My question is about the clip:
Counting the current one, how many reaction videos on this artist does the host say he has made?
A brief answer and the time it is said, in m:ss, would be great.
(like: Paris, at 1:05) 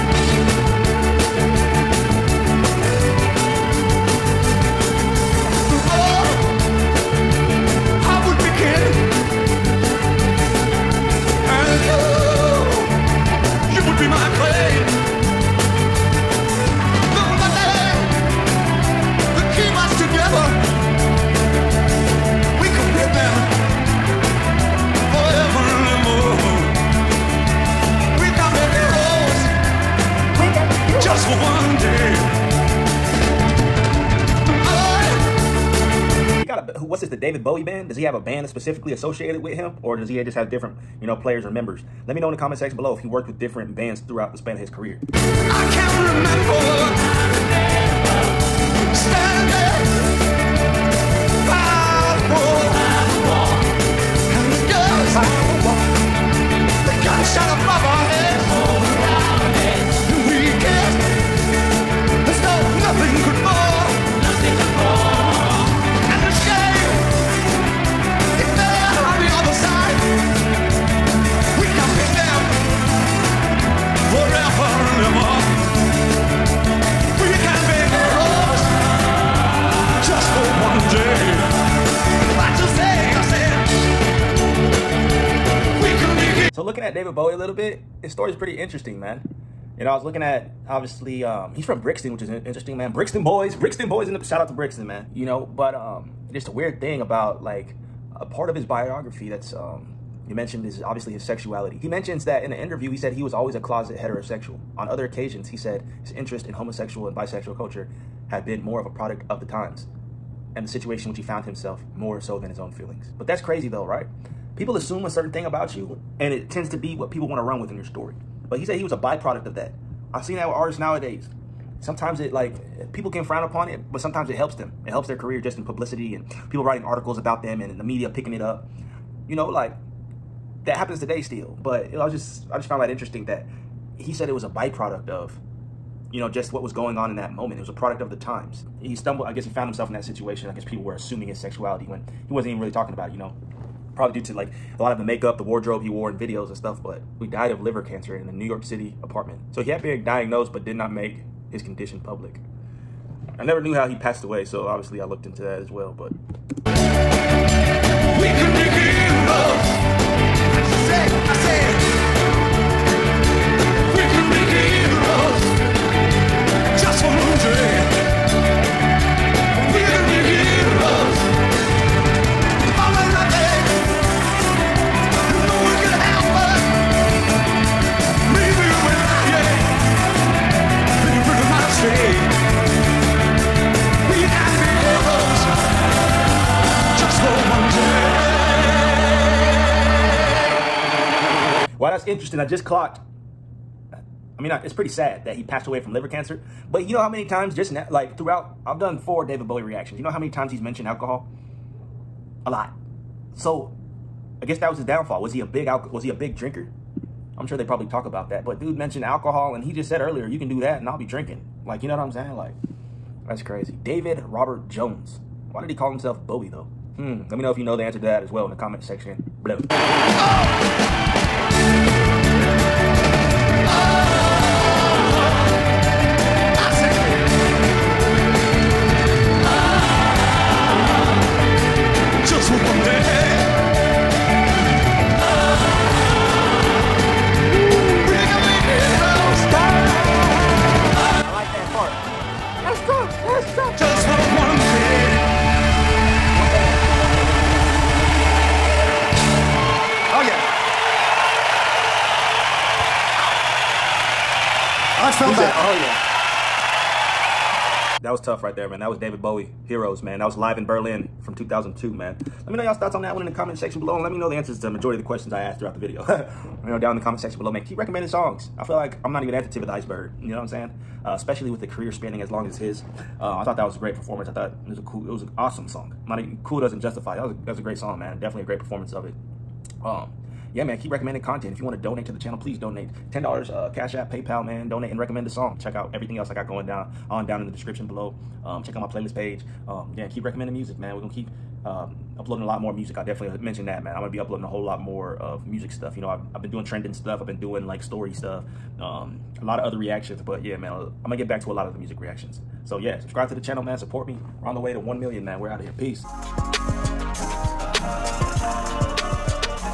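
4, at 3:18.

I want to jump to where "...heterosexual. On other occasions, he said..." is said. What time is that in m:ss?
1:43.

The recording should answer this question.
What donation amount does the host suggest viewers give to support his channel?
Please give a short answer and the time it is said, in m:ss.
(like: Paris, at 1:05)
$10, at 4:43.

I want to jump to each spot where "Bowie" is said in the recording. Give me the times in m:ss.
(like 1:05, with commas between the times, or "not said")
0:37, 1:27, 3:19, 3:36, 4:19.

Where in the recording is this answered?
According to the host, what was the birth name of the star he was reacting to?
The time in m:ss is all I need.
3:33.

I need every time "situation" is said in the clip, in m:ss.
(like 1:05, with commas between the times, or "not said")
1:50, 2:20.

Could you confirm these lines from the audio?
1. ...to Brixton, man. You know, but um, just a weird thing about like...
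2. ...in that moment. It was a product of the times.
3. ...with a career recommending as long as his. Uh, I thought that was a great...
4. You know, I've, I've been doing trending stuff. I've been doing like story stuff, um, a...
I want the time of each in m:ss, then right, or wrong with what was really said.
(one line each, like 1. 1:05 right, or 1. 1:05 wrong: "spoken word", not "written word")
1. 1:34 right
2. 2:17 right
3. 4:31 wrong: "spanning", not "recommending"
4. 4:55 right.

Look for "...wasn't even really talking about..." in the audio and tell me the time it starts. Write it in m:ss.
2:22.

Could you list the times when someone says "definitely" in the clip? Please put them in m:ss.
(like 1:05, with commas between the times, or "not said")
4:38, 4:53.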